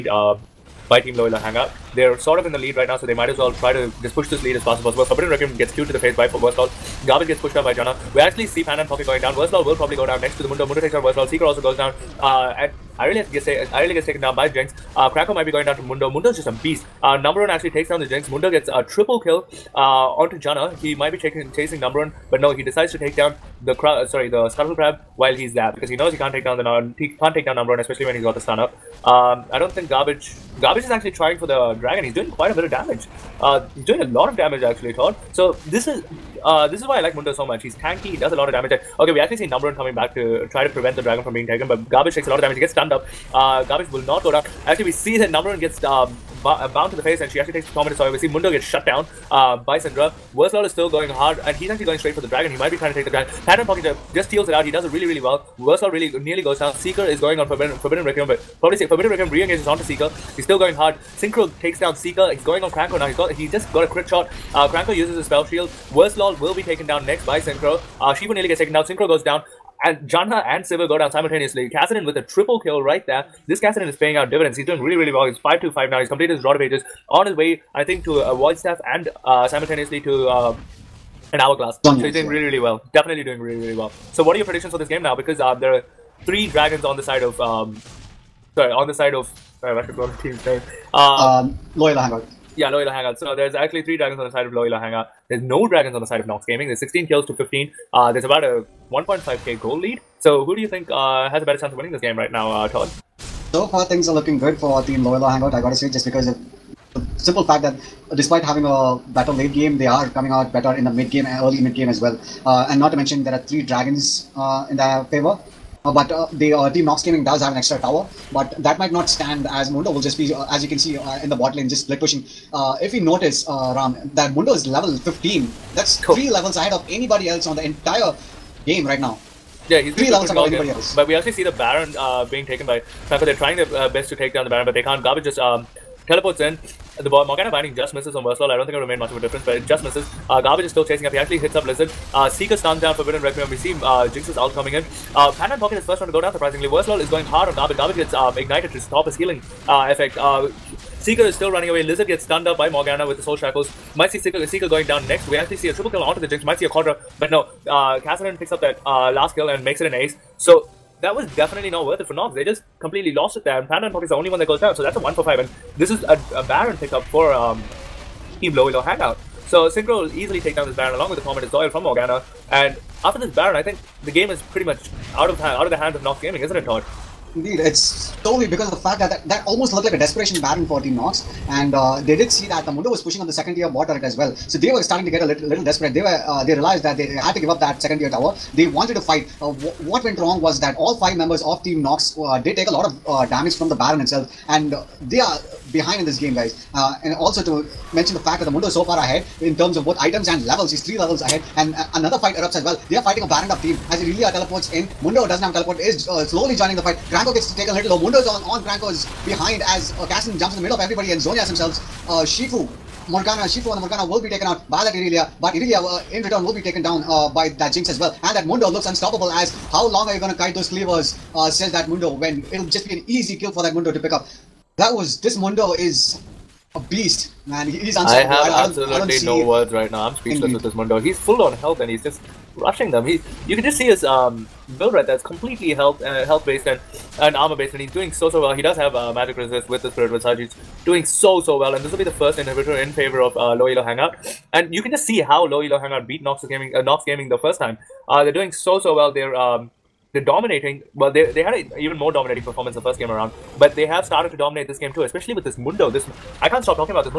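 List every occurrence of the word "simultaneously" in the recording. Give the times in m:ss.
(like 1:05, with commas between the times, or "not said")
1:11, 1:19.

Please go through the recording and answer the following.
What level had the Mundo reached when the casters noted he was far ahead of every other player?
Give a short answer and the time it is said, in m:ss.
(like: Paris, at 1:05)
15, at 2:04.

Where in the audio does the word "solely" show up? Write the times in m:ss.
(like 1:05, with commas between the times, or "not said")
2:58.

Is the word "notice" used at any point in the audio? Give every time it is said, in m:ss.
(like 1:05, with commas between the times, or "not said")
2:02.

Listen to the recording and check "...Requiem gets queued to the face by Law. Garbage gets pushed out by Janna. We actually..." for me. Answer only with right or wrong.
right.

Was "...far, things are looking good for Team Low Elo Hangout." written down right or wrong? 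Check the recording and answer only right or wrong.
right.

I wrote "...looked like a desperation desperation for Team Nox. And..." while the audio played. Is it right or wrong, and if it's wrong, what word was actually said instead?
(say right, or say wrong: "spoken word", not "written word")
wrong: "baron", not "desperation".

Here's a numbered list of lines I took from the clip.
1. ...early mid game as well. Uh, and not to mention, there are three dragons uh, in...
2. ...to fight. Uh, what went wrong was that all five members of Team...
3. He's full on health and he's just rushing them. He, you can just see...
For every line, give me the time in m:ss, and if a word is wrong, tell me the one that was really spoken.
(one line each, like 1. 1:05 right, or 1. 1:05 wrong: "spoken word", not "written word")
1. 1:51 right
2. 3:08 right
3. 3:51 right.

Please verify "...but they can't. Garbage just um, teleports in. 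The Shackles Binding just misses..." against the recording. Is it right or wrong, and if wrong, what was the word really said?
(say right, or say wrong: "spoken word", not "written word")
wrong: "Morgana", not "Shackles".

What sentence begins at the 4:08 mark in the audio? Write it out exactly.
Uh, they're doing so so well.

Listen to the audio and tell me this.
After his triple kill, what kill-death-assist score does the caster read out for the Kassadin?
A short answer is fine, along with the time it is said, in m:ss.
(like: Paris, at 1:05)
5-2-5, at 1:15.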